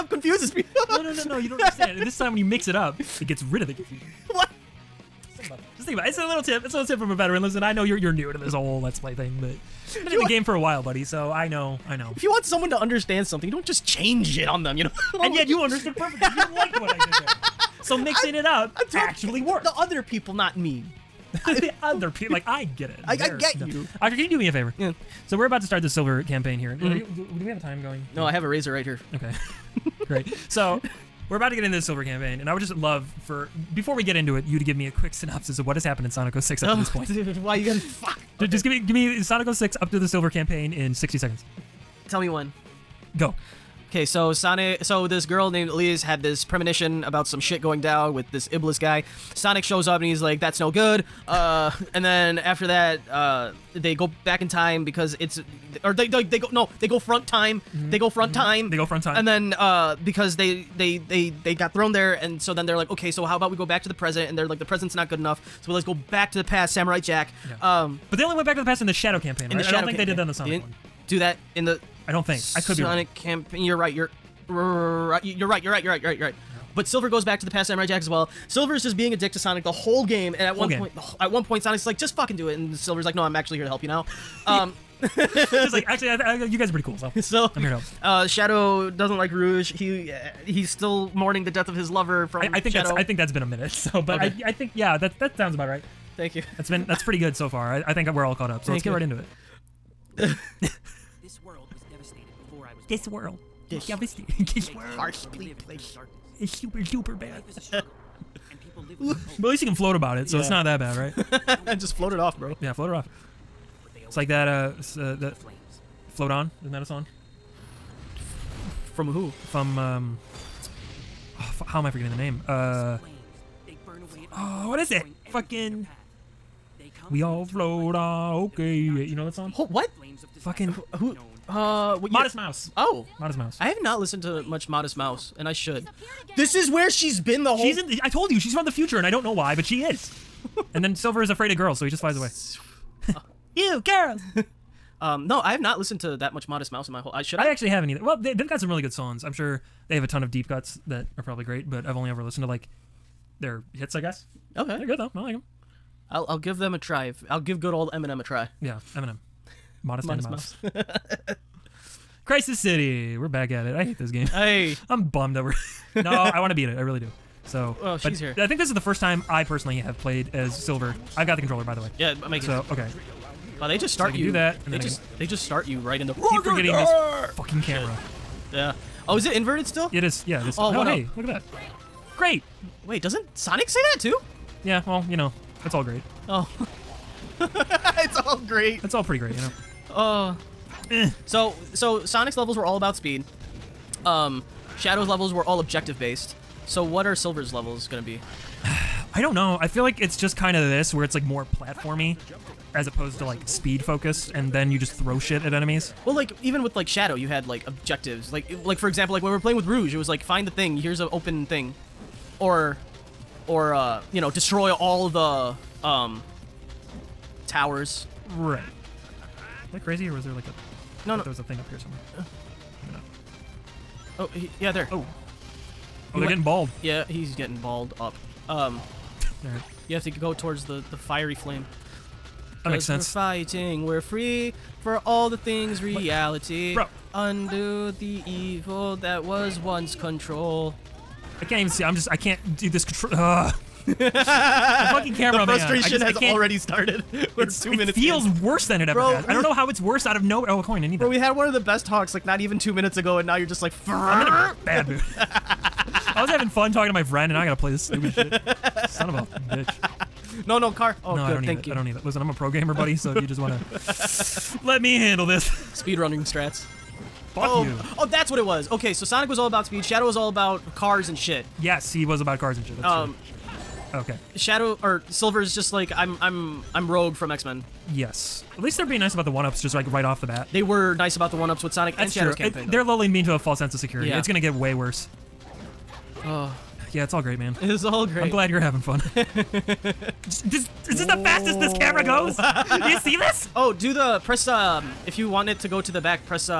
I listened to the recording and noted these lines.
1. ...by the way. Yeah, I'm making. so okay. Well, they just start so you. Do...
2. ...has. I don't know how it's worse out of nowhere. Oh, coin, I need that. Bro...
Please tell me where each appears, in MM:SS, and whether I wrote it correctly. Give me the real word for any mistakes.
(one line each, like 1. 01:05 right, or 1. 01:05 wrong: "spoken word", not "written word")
1. 02:51 right
2. 04:09 right.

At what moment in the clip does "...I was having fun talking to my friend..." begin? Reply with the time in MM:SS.
04:16.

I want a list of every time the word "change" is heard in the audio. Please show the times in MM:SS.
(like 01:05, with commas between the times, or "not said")
00:13.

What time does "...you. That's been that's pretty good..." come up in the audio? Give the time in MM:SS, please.
01:36.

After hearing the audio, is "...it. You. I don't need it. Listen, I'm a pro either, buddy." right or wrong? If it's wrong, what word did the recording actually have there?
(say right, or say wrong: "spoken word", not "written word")
wrong: "gamer", not "either".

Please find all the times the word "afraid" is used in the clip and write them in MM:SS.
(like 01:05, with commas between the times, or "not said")
02:21.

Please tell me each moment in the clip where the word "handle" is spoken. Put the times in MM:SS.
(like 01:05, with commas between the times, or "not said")
04:24.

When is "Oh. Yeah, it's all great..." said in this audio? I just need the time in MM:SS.
04:46.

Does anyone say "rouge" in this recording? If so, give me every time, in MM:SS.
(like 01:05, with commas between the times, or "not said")
01:29, 03:29.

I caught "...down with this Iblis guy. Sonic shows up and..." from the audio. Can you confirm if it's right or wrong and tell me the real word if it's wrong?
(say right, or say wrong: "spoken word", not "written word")
right.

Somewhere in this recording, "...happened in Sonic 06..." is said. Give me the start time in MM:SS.
00:35.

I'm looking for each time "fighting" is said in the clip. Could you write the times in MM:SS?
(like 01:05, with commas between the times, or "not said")
03:53.